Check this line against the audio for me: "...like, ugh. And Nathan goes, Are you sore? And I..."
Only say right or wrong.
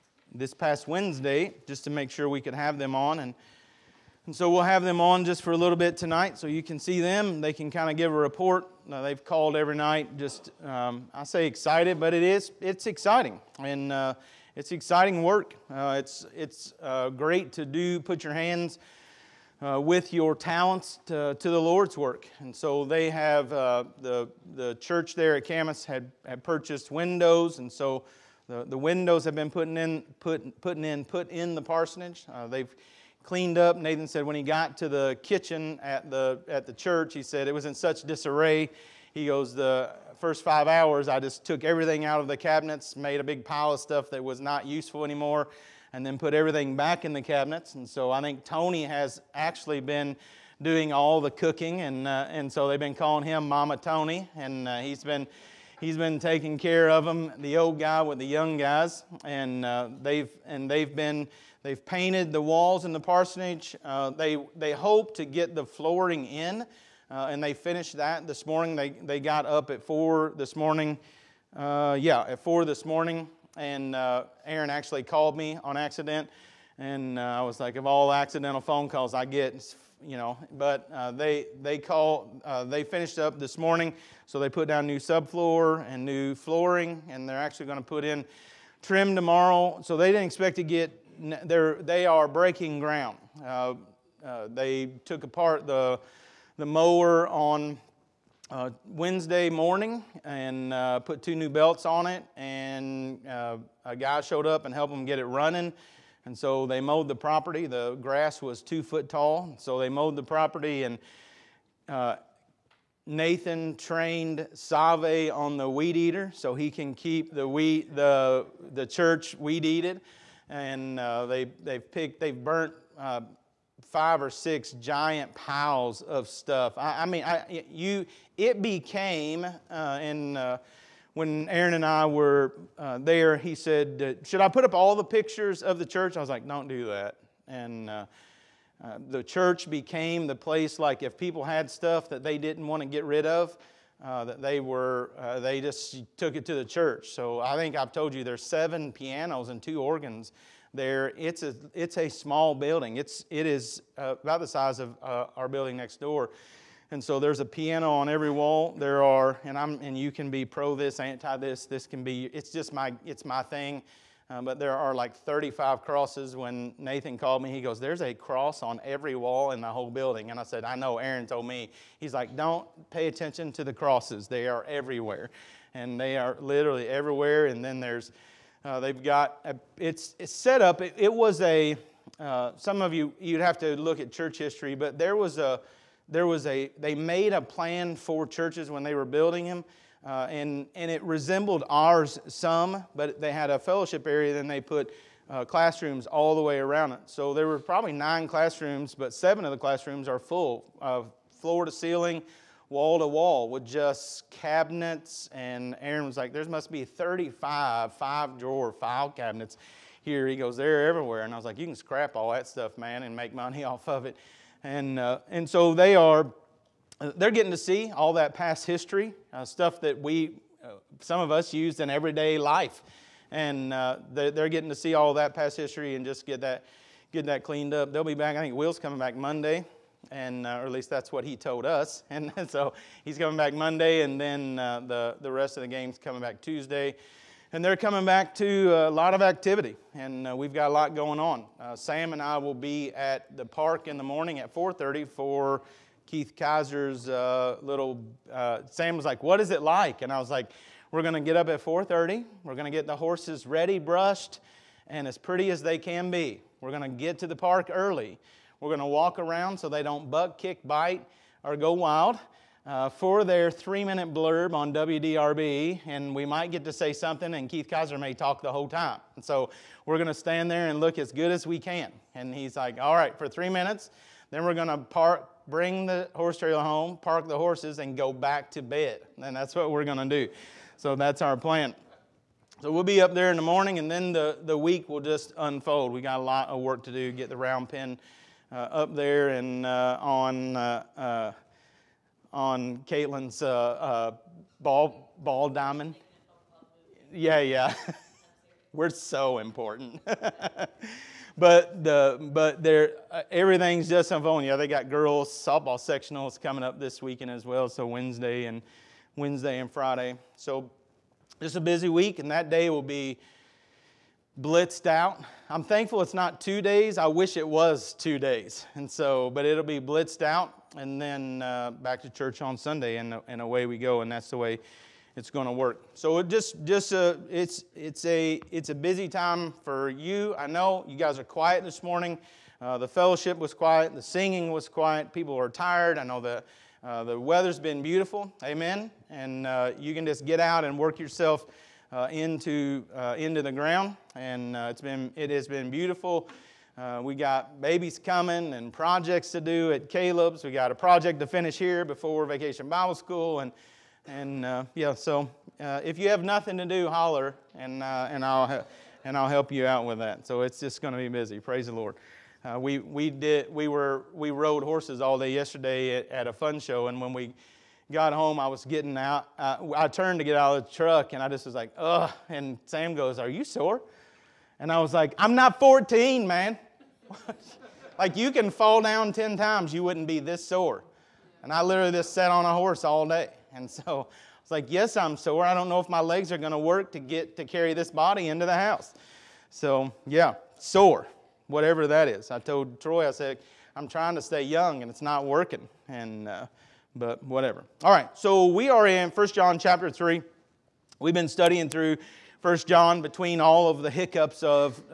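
wrong.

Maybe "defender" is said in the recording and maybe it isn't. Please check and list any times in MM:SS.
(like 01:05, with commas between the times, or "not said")
not said.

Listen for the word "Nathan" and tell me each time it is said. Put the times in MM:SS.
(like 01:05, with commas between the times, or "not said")
00:33, 01:53, 02:46.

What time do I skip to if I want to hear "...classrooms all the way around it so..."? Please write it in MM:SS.
03:15.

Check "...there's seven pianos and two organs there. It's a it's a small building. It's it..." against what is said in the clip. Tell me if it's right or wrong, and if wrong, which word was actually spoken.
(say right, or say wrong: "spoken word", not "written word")
right.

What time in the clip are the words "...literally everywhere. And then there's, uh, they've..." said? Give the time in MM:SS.
02:56.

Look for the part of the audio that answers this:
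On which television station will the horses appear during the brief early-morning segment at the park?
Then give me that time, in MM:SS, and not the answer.
04:24.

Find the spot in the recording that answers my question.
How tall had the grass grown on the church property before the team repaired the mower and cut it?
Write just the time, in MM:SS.
01:48.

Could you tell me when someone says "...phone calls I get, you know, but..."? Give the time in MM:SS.
01:18.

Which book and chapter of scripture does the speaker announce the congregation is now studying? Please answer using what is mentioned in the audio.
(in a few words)
First John chapter 3.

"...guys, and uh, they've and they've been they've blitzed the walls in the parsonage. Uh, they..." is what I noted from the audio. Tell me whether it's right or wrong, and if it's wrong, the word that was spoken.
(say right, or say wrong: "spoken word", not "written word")
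wrong: "painted", not "blitzed".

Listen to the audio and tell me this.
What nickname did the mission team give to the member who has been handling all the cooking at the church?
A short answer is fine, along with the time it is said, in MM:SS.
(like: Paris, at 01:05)
Mama Tony, at 00:53.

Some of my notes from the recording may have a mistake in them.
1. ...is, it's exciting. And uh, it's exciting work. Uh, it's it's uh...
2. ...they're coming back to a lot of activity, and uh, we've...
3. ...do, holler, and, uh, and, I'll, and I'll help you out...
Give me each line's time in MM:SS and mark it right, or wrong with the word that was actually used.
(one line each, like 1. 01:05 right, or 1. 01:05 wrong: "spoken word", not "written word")
1. 00:12 right
2. 03:57 right
3. 05:56 right.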